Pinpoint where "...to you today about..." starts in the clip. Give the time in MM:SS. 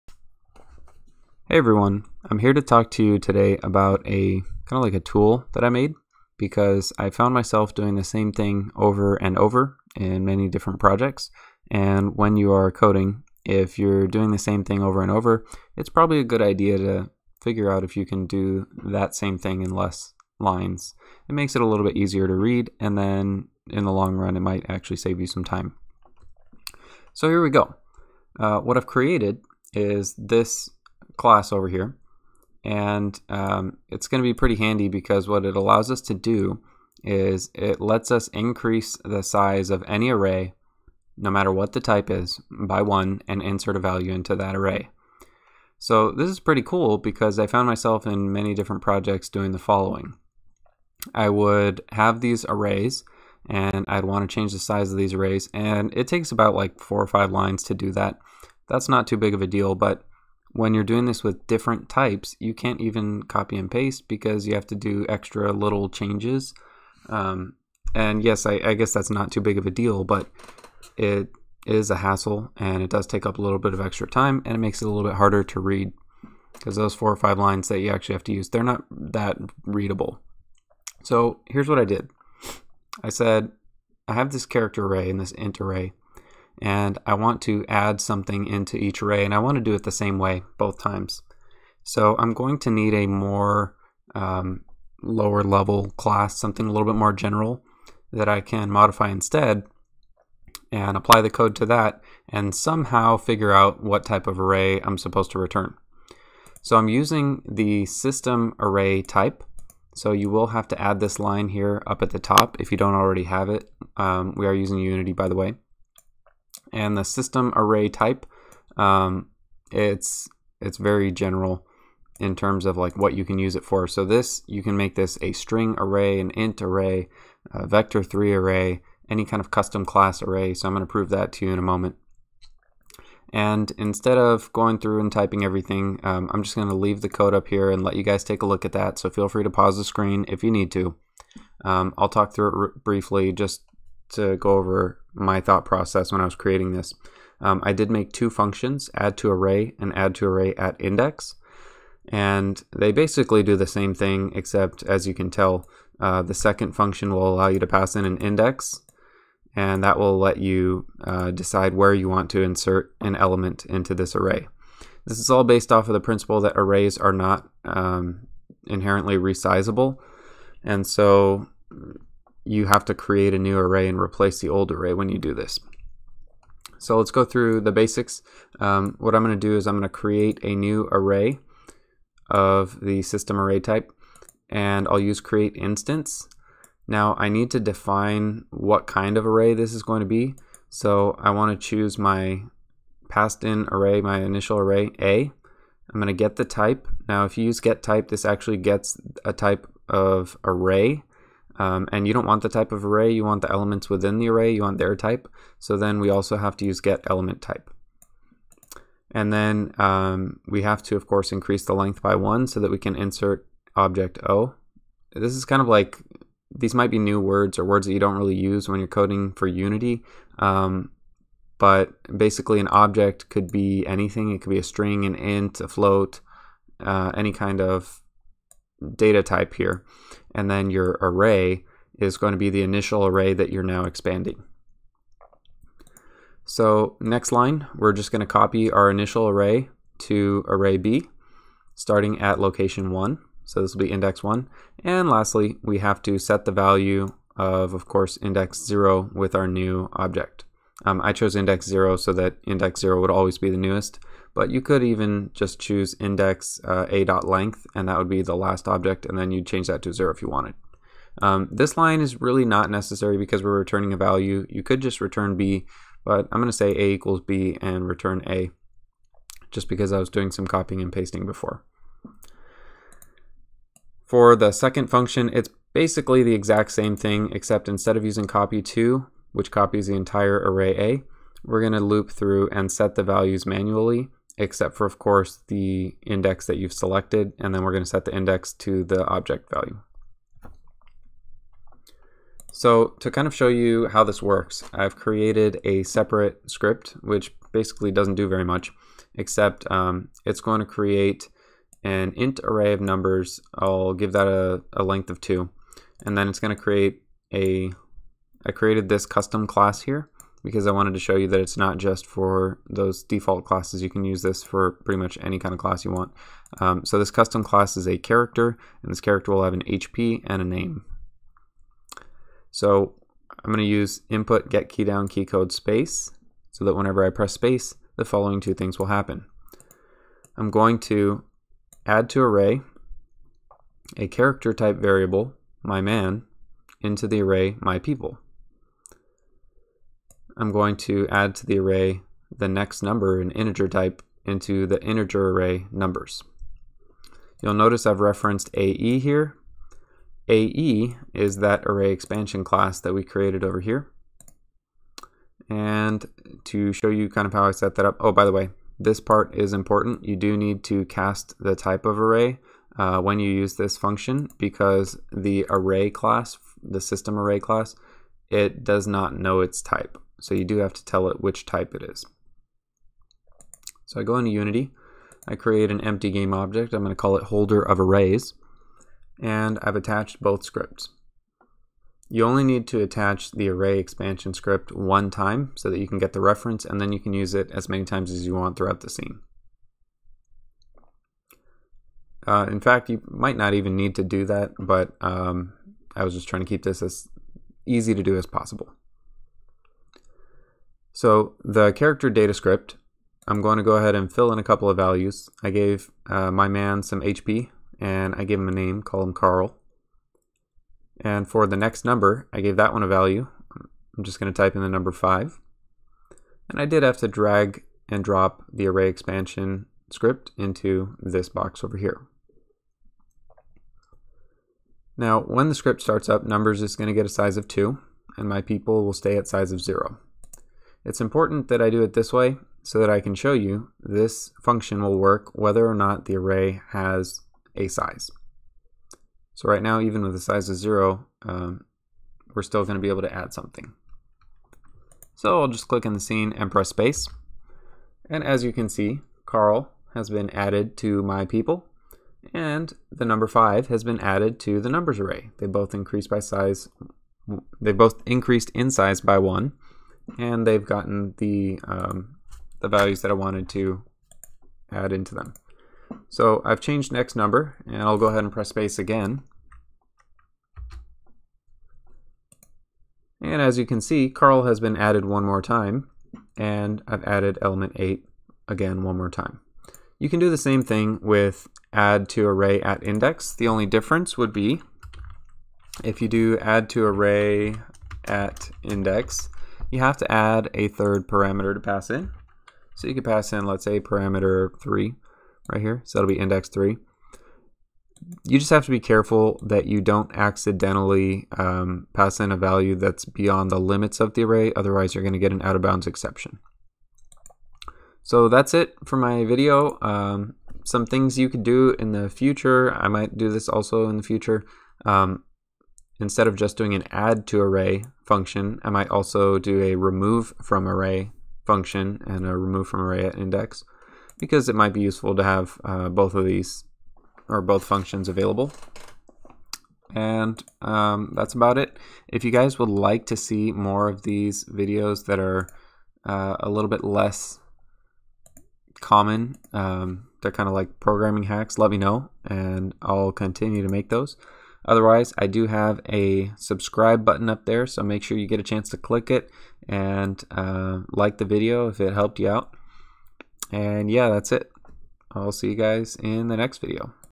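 00:02.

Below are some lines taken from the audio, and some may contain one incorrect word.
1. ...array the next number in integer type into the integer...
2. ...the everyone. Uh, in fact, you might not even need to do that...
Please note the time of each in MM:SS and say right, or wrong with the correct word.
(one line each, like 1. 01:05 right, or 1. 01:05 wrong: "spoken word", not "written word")
1. 05:41 right
2. 06:28 wrong: "scene", not "everyone".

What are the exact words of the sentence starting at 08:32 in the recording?
I might do this also in the future.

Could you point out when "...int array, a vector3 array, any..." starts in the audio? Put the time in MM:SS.
02:06.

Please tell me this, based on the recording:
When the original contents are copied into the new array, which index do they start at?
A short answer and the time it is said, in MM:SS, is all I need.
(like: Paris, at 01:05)
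1, at 04:03.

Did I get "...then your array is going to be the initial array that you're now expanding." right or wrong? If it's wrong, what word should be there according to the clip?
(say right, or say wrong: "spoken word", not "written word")
right.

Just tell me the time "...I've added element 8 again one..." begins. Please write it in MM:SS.
07:56.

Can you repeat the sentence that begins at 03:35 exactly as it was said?
This is kind of like, these might be new words or words that you don't really use when you're coding for Unity.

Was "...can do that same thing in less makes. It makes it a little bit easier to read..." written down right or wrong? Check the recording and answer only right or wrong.
wrong.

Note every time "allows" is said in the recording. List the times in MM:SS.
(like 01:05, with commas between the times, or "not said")
00:35, 02:37.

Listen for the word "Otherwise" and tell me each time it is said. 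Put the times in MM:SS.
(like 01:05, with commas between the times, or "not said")
08:24, 09:04.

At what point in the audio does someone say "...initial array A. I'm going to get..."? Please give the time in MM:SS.
03:14.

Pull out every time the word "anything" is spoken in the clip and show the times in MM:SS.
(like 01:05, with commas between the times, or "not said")
03:43.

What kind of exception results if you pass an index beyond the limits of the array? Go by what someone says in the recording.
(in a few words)
out-of-bounds exception.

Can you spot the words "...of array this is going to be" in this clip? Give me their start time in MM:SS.
03:09.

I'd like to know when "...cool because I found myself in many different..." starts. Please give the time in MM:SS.
00:46.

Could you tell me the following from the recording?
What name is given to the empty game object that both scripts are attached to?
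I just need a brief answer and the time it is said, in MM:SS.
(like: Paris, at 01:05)
holder of arrays, at 06:17.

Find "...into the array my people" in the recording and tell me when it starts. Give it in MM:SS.
05:36.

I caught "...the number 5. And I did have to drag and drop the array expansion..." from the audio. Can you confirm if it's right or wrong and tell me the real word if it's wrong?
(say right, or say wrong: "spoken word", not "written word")
right.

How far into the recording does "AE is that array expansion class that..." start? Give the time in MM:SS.
05:50.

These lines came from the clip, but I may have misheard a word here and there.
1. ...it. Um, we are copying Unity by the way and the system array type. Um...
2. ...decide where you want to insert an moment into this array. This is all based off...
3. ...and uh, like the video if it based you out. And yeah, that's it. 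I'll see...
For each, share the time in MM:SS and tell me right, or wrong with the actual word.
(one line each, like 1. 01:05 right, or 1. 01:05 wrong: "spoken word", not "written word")
1. 01:53 wrong: "using", not "copying"
2. 02:41 wrong: "element", not "moment"
3. 09:09 wrong: "helped", not "based".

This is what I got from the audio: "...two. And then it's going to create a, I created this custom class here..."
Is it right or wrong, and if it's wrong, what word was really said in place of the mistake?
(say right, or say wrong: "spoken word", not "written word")
right.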